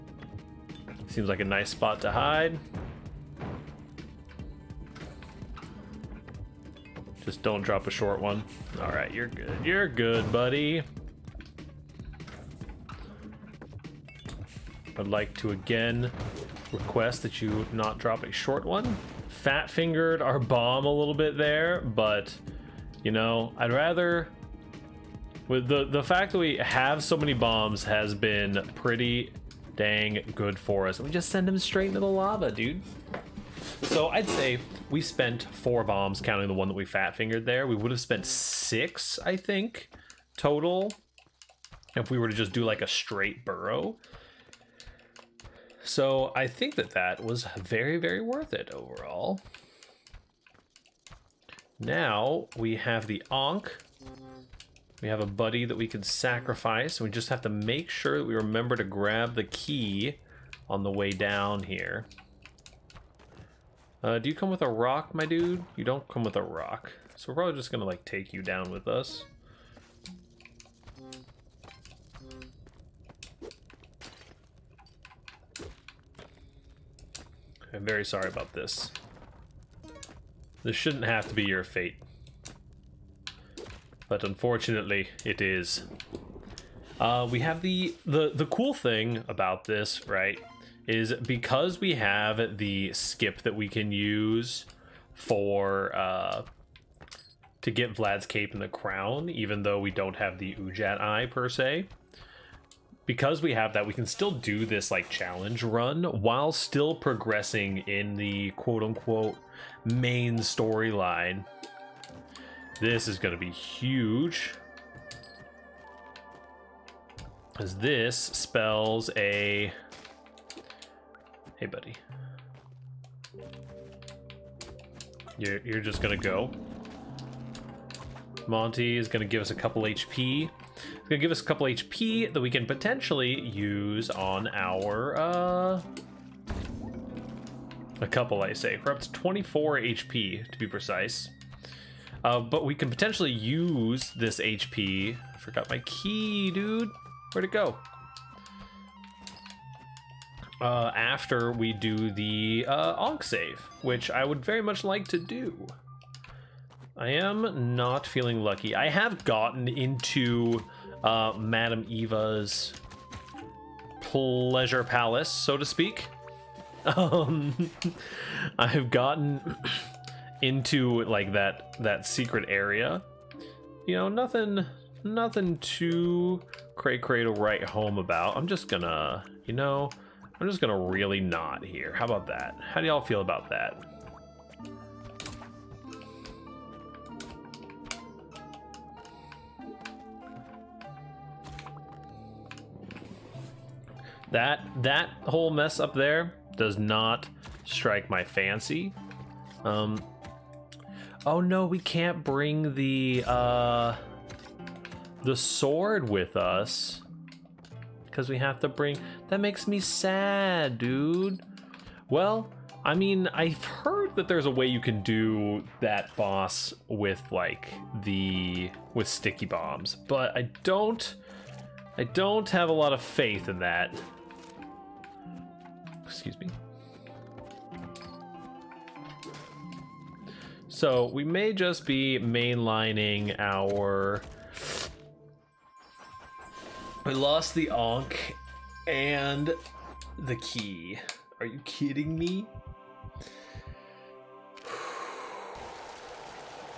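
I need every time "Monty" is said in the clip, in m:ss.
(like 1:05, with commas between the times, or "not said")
2:08.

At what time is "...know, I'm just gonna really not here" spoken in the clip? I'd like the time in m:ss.
2:59.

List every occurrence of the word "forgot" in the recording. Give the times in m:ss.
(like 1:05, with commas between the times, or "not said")
2:25.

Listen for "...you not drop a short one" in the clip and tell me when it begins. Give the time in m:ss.
0:17.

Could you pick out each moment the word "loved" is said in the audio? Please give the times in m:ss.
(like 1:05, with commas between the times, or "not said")
not said.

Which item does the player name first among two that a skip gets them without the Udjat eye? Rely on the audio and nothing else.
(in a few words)
Vlad's cape.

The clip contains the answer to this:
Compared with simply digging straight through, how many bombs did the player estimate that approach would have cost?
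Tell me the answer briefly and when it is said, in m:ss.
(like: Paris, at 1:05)
6, at 0:38.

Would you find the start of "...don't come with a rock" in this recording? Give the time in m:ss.
1:05.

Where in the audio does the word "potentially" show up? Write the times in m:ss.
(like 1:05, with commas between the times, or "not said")
2:12, 2:22.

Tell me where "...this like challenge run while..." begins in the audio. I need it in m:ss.
1:44.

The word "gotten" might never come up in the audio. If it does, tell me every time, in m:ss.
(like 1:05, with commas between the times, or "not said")
2:39, 2:48.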